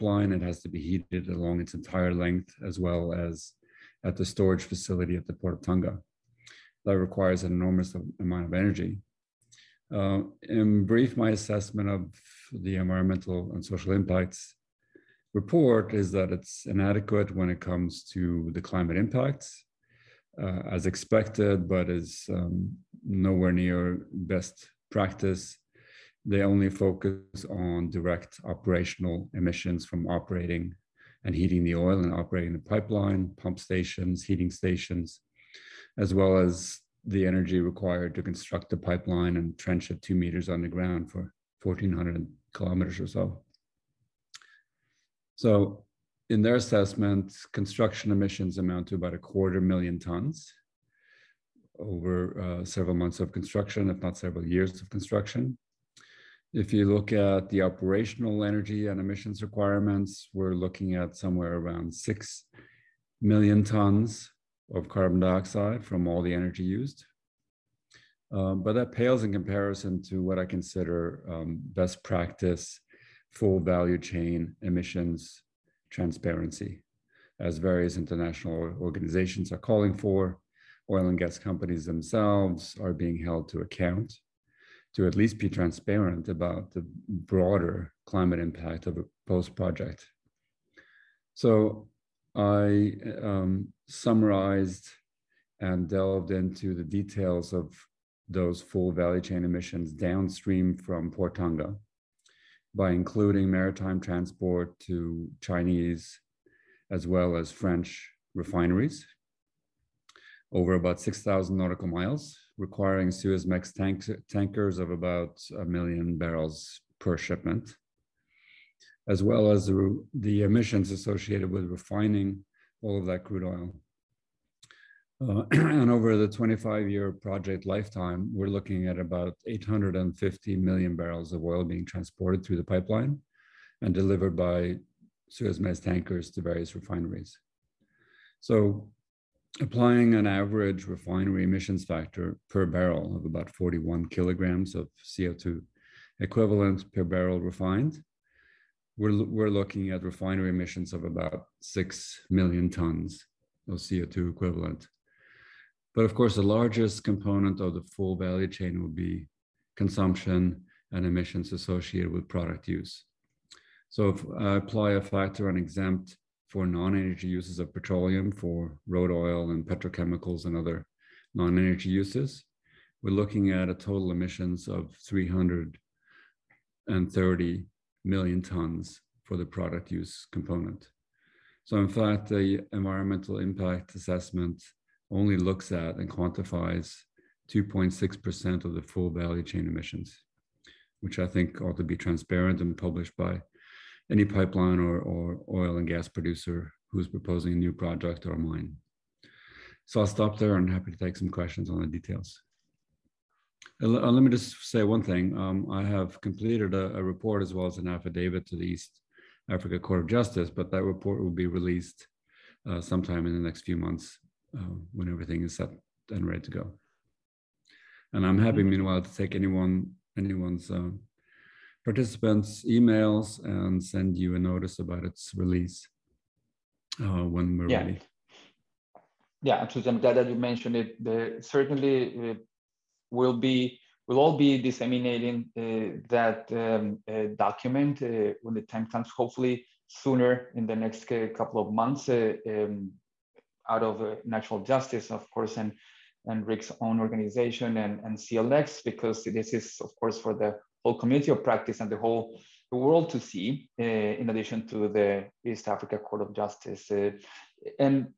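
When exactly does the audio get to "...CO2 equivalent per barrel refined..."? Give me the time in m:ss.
2:25.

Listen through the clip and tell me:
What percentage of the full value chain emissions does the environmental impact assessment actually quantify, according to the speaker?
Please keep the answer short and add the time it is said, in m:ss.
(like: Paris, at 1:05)
2.6%, at 3:07.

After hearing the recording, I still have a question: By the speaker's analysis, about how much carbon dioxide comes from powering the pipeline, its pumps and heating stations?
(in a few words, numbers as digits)
6 million tons.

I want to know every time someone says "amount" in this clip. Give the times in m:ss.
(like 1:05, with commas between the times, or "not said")
0:08, 0:48.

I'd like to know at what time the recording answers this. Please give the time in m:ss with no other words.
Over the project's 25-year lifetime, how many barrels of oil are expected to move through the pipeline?
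2:09.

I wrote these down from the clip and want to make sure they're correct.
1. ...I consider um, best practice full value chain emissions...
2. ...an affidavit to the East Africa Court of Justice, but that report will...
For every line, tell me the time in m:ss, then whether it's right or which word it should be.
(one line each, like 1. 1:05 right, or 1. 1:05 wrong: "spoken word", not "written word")
1. 1:10 right
2. 3:27 right.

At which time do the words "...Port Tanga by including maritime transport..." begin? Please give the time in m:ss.
1:41.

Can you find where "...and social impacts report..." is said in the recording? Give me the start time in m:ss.
0:13.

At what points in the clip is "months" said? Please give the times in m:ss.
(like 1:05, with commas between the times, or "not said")
0:52, 3:33, 4:01.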